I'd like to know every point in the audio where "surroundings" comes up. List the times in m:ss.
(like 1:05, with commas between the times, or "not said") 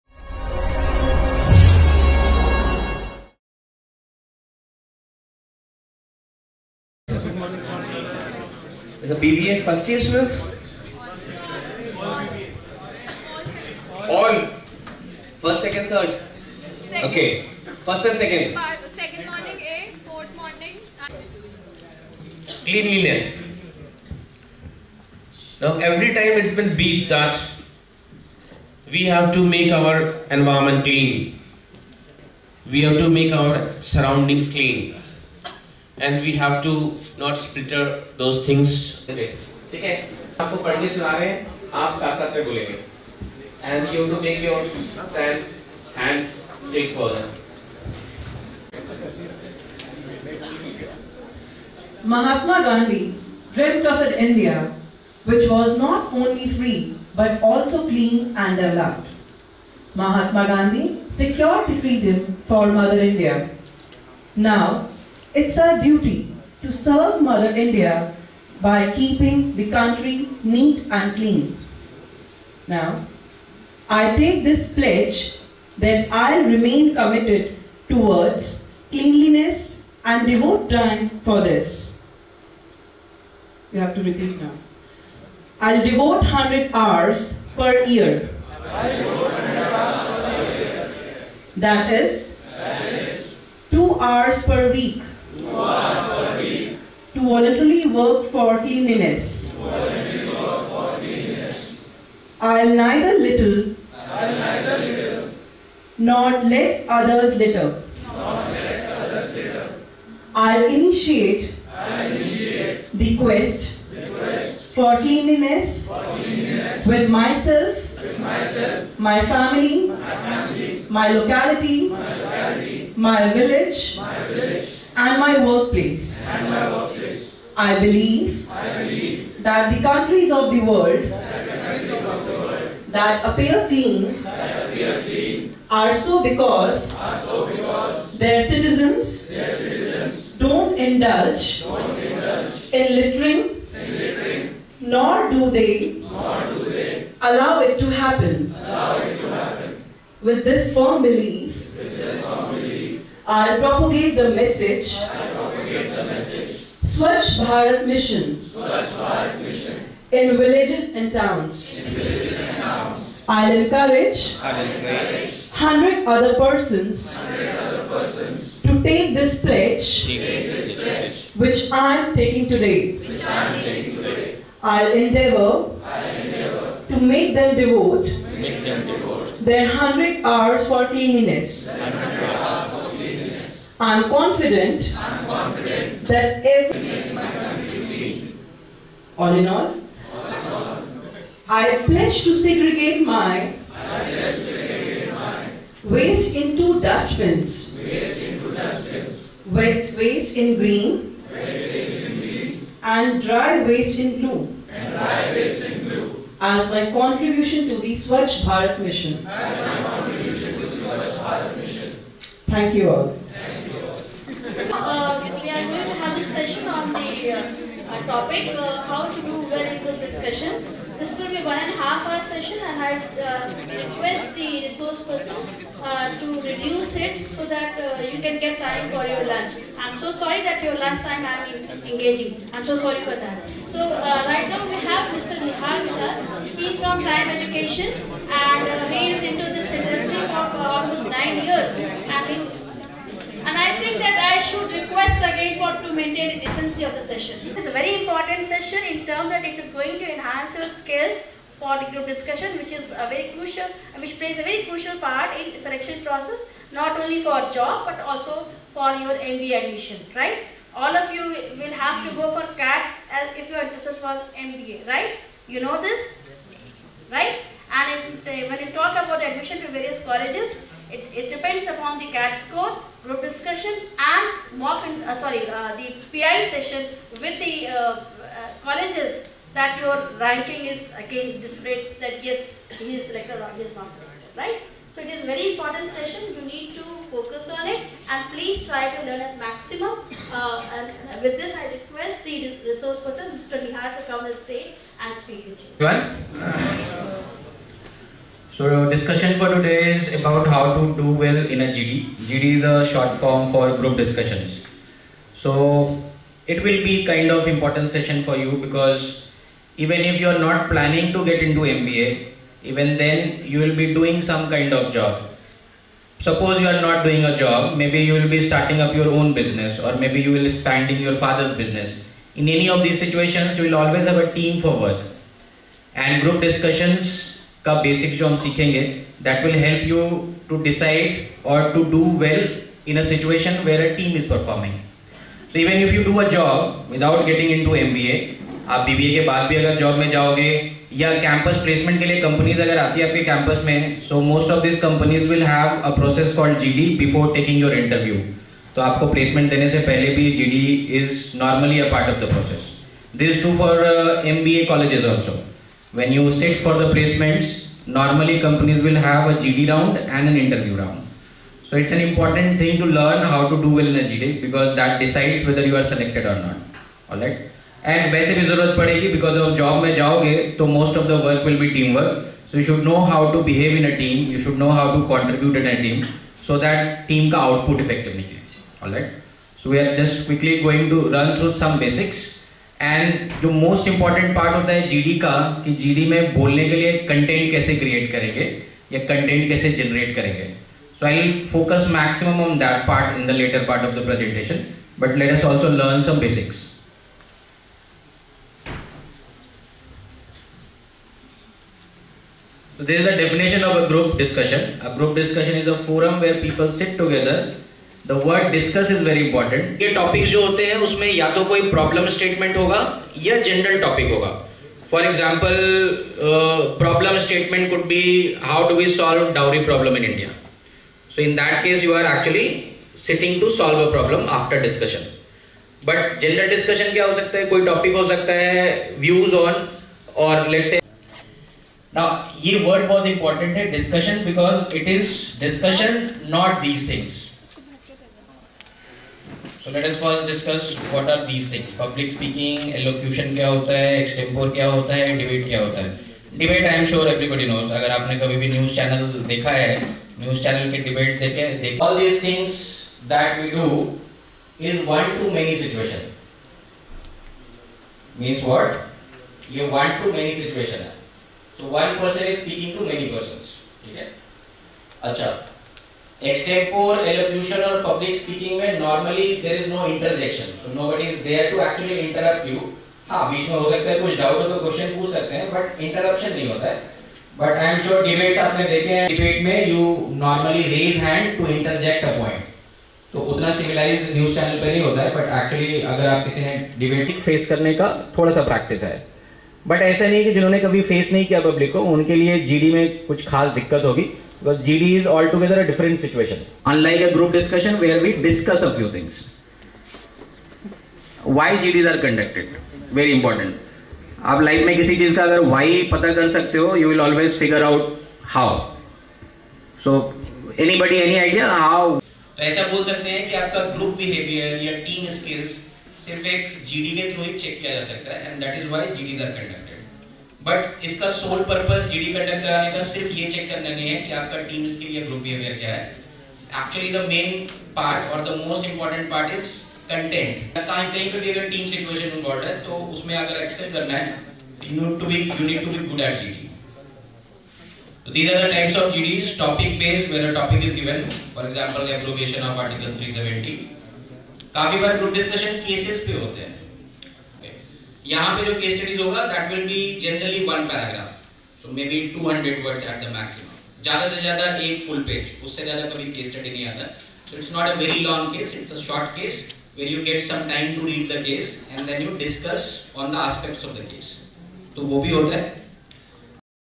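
0:33.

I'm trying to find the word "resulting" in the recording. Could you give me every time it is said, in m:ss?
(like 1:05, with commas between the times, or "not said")
not said.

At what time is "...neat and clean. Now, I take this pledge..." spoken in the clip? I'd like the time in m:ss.
1:10.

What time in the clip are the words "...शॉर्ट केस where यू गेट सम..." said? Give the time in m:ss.
9:18.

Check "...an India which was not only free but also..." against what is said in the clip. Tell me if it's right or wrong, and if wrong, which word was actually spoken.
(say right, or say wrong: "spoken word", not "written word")
right.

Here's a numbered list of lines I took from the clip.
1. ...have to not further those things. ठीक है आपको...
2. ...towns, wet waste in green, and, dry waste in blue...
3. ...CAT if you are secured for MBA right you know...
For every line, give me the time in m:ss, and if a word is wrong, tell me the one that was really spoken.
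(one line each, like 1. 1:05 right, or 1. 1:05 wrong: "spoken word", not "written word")
1. 0:36 wrong: "splitter", not "further"
2. 3:16 wrong: "dustbins", not "towns"
3. 4:22 wrong: "interested", not "secured".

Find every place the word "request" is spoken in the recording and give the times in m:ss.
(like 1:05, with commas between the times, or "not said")
3:43, 4:04, 4:51.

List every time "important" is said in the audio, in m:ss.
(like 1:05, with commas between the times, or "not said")
4:08, 4:45, 5:07, 6:02, 6:49, 8:23.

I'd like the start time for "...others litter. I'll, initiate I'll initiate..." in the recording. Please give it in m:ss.
1:48.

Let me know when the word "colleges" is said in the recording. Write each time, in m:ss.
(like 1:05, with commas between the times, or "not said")
4:30, 4:38.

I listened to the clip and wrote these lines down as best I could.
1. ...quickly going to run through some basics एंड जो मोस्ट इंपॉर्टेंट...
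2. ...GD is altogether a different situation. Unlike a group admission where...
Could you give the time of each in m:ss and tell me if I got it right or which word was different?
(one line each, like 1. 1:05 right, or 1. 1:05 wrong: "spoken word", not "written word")
1. 6:20 right
2. 8:14 wrong: "discussion", not "admission".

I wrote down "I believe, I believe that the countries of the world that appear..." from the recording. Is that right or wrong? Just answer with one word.
right.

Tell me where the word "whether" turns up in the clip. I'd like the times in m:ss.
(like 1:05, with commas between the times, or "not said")
6:05.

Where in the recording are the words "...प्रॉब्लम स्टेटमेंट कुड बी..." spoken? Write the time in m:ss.
6:56.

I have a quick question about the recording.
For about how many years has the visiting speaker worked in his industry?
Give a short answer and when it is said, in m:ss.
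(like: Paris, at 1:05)
9 years, at 4:01.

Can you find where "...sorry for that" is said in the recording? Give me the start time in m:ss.
3:52.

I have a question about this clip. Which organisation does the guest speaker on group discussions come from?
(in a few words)
Time Education.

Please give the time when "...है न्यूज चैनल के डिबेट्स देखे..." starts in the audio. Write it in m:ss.
7:29.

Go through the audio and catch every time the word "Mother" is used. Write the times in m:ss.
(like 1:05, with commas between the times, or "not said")
1:02, 1:07.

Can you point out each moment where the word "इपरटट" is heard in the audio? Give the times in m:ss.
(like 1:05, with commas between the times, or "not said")
6:23, 7:13, 8:48.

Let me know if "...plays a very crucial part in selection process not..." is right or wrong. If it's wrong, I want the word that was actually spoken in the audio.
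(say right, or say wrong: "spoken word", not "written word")
right.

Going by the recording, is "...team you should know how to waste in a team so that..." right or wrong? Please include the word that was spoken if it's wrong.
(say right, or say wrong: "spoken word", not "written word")
wrong: "contribute", not "waste".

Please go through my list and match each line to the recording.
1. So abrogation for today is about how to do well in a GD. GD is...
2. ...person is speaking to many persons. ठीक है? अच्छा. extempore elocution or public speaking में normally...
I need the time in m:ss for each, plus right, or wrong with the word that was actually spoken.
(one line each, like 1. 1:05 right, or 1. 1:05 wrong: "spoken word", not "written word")
1. 4:58 wrong: "discussion", not "abrogation"
2. 7:42 right.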